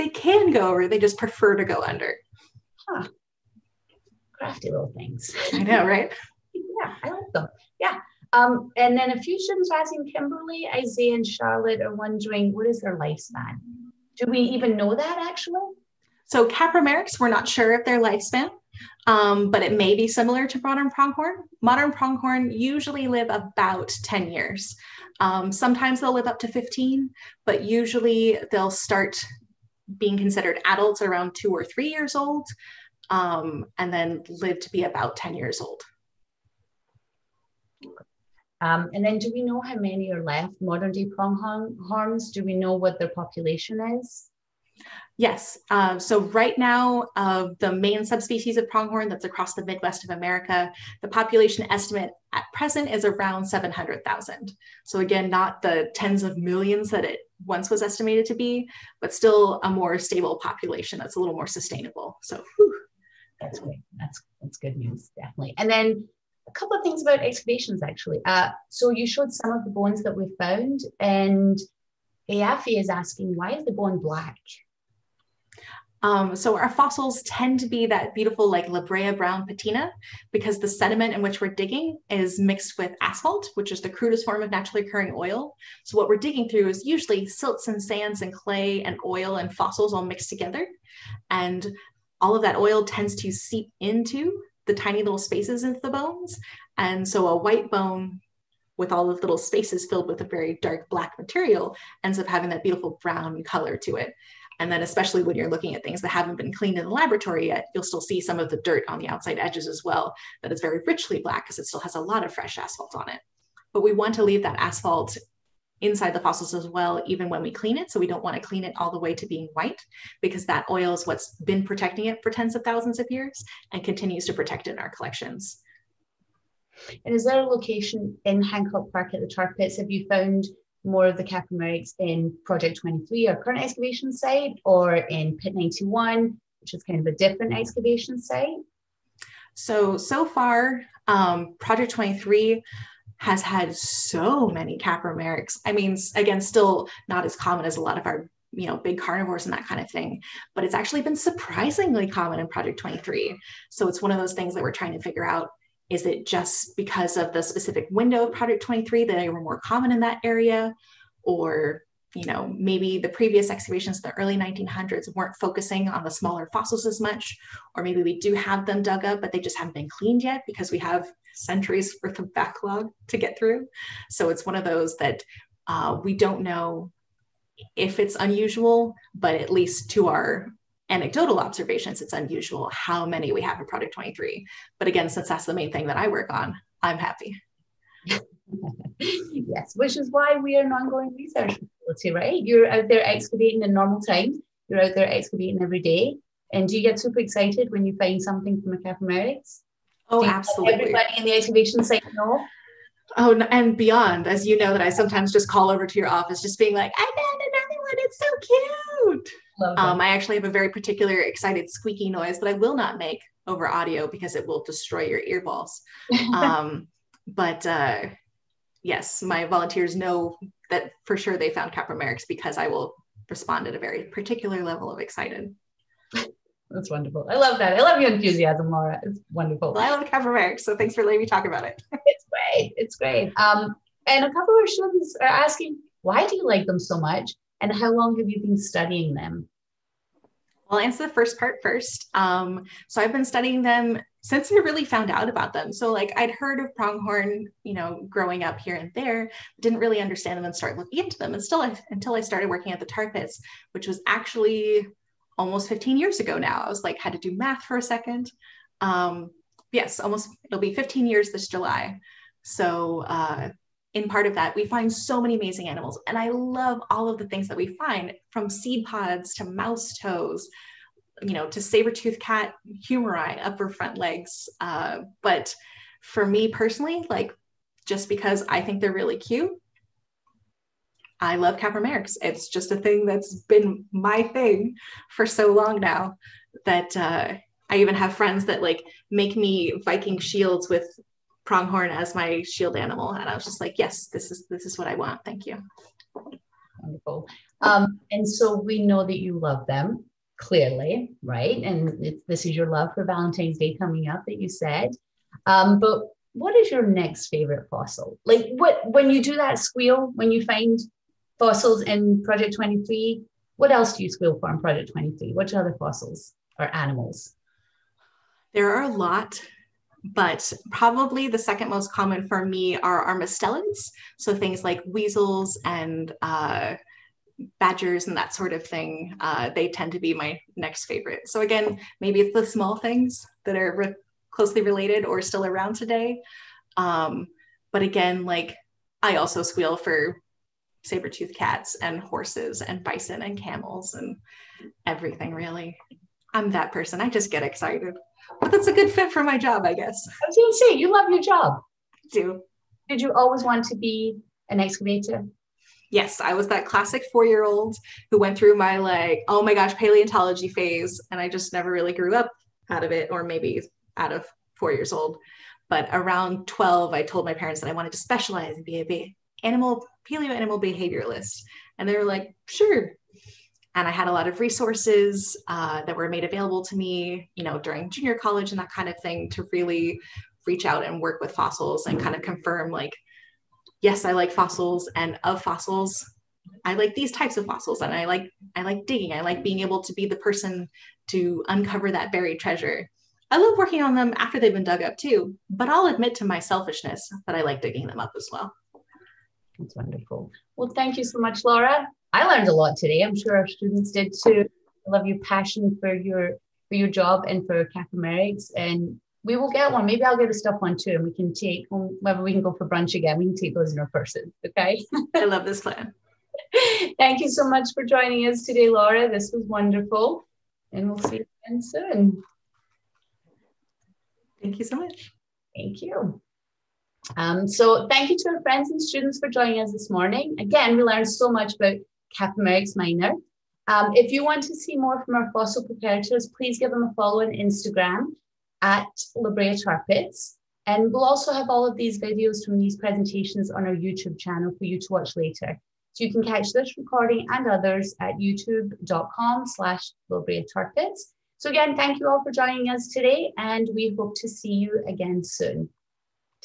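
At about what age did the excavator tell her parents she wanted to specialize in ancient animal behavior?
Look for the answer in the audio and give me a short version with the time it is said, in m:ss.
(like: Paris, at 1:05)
12, at 6:05.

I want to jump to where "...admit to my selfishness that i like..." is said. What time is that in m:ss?
6:35.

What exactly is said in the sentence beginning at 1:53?
But we want to leave that asphalt inside the fossils as well, even when we clean it.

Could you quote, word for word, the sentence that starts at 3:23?
Oh, and beyond, as you know, that I sometimes just call over to your office, just being like, I found another one.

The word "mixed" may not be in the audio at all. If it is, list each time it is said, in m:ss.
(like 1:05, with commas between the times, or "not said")
1:22, 1:30.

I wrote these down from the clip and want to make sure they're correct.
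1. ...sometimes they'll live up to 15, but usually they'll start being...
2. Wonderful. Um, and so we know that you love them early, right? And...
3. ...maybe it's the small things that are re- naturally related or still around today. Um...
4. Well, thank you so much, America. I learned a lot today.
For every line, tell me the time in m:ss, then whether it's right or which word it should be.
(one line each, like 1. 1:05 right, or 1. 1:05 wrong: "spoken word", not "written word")
1. 0:25 right
2. 4:56 wrong: "clearly", not "early"
3. 5:32 wrong: "closely", not "naturally"
4. 6:40 wrong: "Laura", not "America".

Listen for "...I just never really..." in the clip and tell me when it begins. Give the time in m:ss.
6:01.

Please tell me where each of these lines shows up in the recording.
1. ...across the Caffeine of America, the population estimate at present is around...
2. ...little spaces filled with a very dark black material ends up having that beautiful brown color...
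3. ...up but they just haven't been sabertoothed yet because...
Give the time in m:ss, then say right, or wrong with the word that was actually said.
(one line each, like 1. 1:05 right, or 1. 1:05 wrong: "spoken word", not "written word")
1. 0:49 wrong: "Midwest", not "Caffeine"
2. 1:39 right
3. 2:49 wrong: "cleaned", not "sabertoothed".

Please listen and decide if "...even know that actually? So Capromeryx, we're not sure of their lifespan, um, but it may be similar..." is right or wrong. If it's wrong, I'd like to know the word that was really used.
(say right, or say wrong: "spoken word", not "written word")
right.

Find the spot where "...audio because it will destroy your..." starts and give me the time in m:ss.
3:33.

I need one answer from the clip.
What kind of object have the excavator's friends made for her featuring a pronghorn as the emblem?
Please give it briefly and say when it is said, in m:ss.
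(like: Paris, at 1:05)
Viking shields, at 4:49.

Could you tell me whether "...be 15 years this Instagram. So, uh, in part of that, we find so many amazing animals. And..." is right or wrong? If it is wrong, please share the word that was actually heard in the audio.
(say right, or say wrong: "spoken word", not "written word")
wrong: "July", not "Instagram".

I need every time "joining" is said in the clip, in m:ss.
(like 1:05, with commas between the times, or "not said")
6:57, 7:09, 7:32.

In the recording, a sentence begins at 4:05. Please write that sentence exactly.
So like I'd heard of pronghorn, you know, growing up here and there, didn't really understand them and start looking into them.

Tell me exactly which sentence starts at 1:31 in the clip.
And all of that oil tends to seep into the tiny little spaces into the bones.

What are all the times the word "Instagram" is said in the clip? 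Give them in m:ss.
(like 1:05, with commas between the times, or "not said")
7:17.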